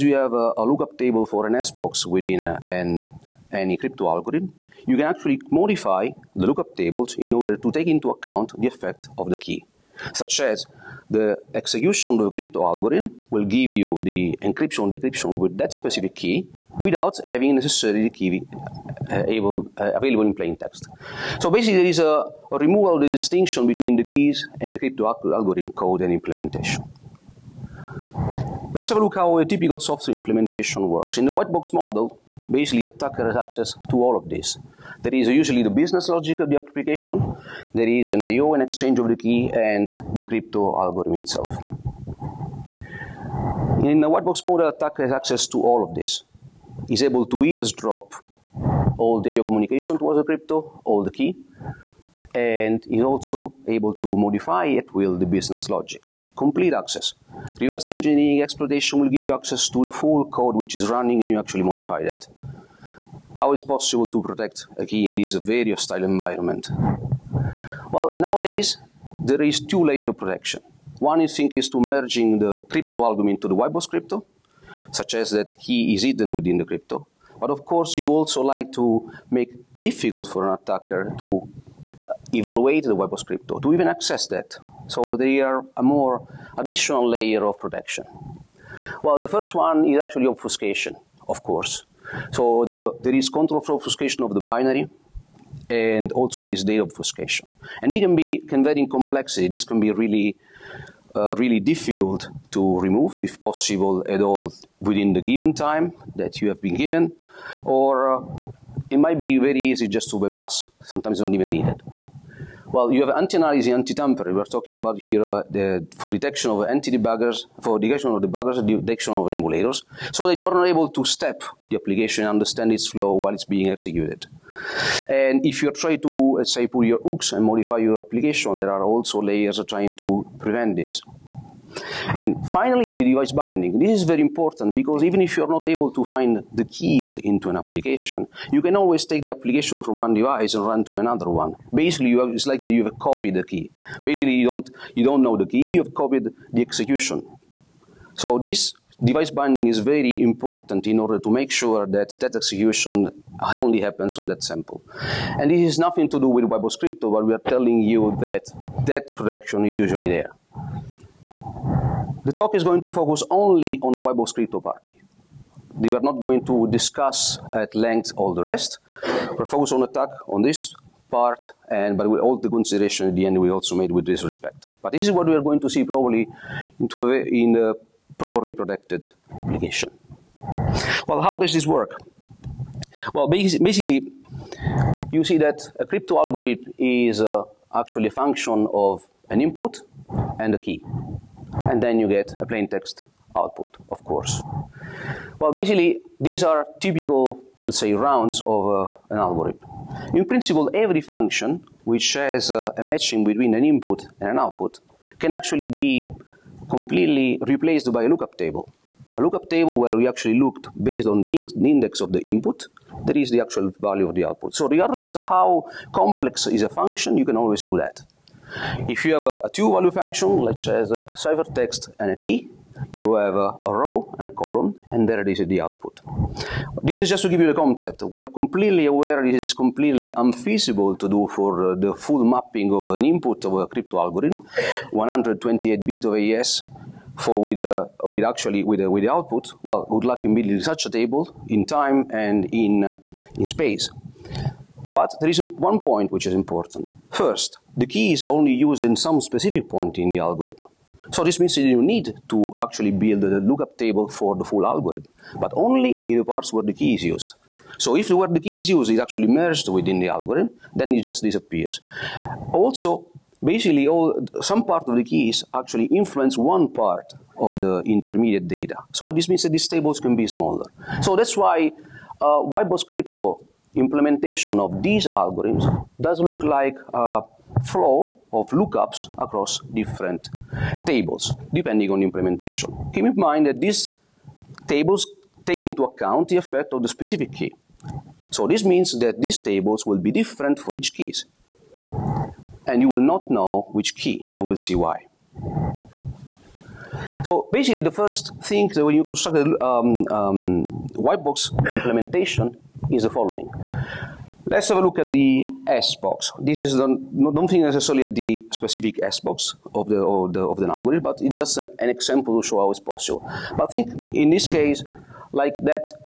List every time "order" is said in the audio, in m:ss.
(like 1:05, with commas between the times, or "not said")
0:07, 2:30.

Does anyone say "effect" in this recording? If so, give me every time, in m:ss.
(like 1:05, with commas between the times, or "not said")
0:08, 4:46.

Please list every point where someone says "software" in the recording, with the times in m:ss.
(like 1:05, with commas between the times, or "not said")
0:29.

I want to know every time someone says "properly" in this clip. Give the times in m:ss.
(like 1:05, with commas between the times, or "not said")
2:58.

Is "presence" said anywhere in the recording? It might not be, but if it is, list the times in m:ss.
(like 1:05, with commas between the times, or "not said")
not said.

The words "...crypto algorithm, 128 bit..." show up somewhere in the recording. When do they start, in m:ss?
3:53.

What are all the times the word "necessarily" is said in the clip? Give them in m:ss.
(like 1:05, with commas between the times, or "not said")
0:17, 5:07.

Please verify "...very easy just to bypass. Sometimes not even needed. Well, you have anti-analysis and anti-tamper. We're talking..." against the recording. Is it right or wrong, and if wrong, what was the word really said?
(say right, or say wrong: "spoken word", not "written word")
right.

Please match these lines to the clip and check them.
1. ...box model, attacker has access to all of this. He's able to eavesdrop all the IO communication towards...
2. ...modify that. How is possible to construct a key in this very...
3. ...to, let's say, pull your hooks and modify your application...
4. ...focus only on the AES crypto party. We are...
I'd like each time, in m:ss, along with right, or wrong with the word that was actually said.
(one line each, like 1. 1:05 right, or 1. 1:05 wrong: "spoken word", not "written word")
1. 0:44 right
2. 1:01 wrong: "protect", not "construct"
3. 2:05 right
4. 2:42 wrong: "Webos", not "AES".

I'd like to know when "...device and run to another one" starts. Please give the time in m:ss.
2:20.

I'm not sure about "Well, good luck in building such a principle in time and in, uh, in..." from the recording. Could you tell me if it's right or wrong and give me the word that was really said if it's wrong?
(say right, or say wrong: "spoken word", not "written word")
wrong: "table", not "principle".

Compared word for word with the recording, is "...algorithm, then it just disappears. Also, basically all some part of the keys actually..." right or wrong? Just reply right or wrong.
right.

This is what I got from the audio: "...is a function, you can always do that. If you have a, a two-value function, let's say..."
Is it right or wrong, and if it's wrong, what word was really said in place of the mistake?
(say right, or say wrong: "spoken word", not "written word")
right.